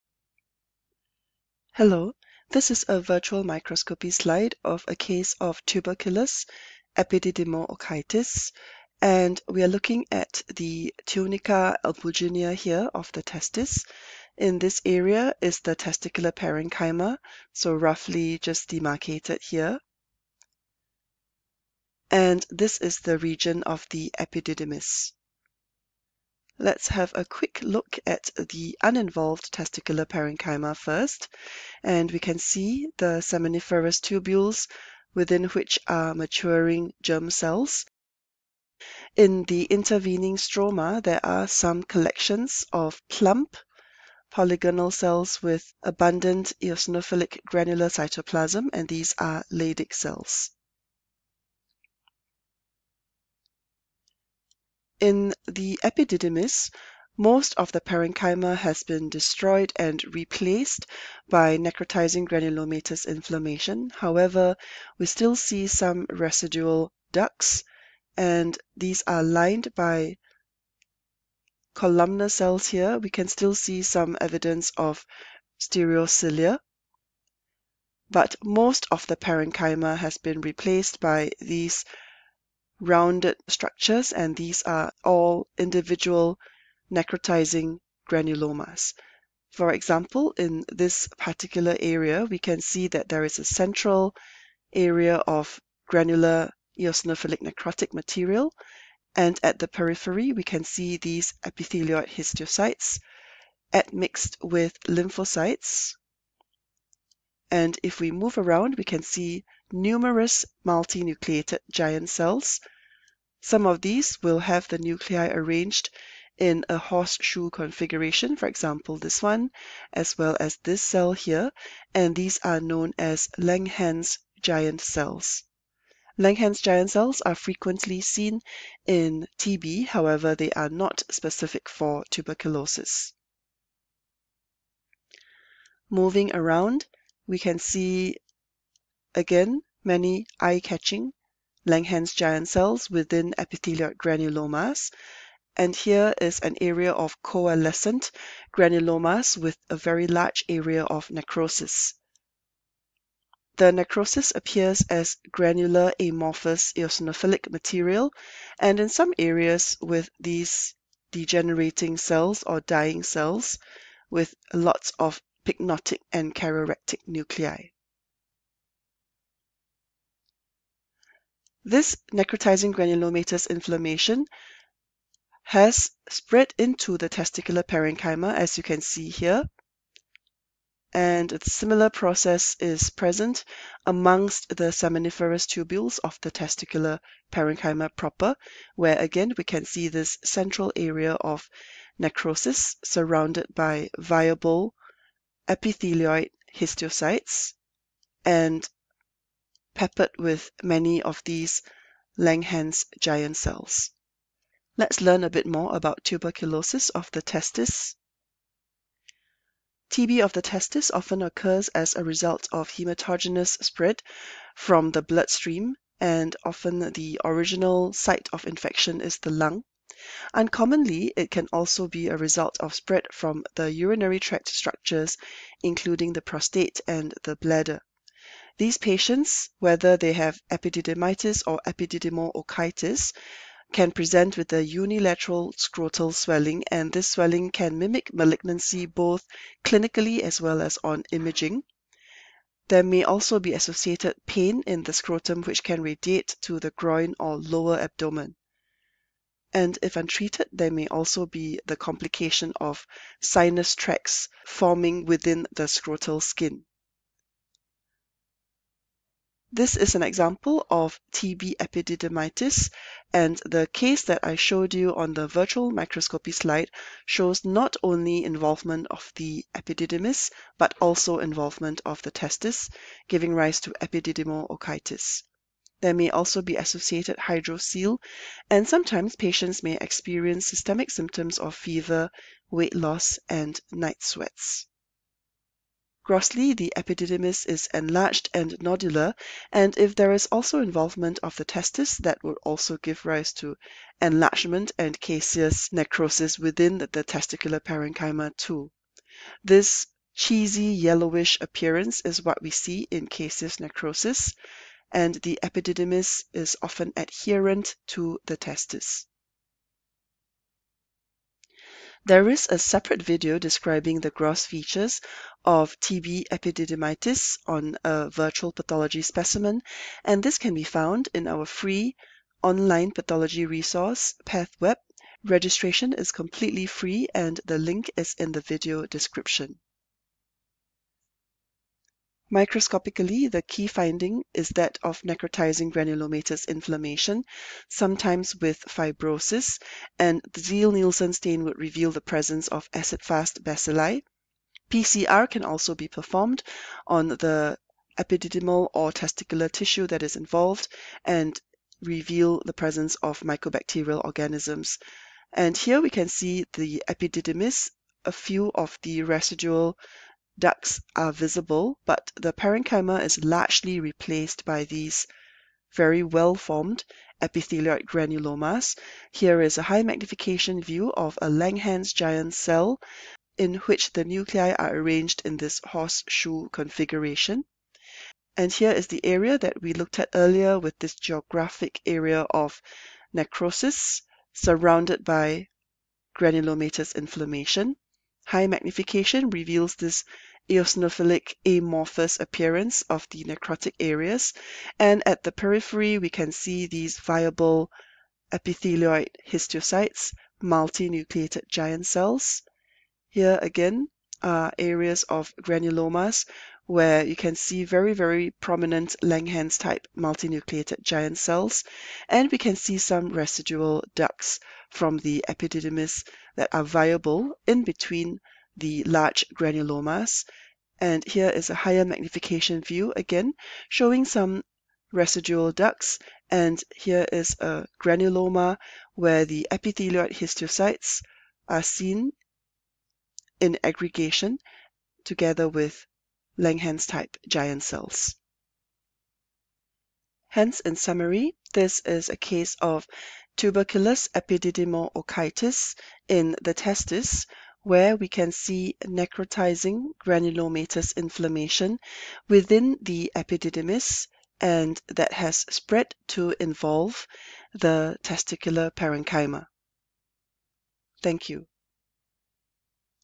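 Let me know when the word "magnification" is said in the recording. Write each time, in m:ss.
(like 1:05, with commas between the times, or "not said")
6:09, 6:28, 7:01.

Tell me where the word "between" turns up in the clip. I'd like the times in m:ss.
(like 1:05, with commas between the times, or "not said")
6:57.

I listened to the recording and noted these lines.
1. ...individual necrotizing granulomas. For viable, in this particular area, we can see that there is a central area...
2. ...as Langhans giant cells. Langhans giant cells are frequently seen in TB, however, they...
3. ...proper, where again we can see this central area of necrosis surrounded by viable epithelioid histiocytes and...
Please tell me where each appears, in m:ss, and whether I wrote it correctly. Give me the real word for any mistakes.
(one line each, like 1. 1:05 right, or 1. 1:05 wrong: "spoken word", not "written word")
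1. 1:25 wrong: "example", not "viable"
2. 2:02 right
3. 3:07 right.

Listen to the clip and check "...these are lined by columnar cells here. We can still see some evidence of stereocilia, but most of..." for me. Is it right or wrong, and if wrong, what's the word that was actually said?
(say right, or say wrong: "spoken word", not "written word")
right.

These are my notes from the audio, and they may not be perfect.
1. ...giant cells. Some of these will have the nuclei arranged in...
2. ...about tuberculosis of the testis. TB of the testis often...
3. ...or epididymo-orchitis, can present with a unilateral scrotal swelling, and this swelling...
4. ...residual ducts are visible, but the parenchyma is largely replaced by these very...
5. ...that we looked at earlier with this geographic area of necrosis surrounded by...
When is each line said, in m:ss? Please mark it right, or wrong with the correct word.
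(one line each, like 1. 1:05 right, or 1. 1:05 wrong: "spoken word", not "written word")
1. 1:51 right
2. 3:25 right
3. 3:51 right
4. 5:59 right
5. 6:19 right.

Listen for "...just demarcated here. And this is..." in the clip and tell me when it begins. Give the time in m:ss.
0:18.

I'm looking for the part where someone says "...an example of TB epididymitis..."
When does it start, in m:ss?
4:19.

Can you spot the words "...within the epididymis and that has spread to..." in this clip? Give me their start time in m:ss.
7:32.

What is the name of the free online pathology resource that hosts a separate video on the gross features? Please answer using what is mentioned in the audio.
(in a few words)
PathWeb.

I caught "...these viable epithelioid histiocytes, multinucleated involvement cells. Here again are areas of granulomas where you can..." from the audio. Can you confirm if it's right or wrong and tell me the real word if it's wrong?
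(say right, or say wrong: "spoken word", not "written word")
wrong: "giant", not "involvement".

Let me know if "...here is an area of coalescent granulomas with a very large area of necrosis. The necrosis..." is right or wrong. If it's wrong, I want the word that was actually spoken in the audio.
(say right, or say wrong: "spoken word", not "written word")
right.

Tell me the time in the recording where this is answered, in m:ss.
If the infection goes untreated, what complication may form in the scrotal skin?
4:13.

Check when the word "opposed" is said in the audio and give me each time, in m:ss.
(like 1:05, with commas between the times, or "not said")
not said.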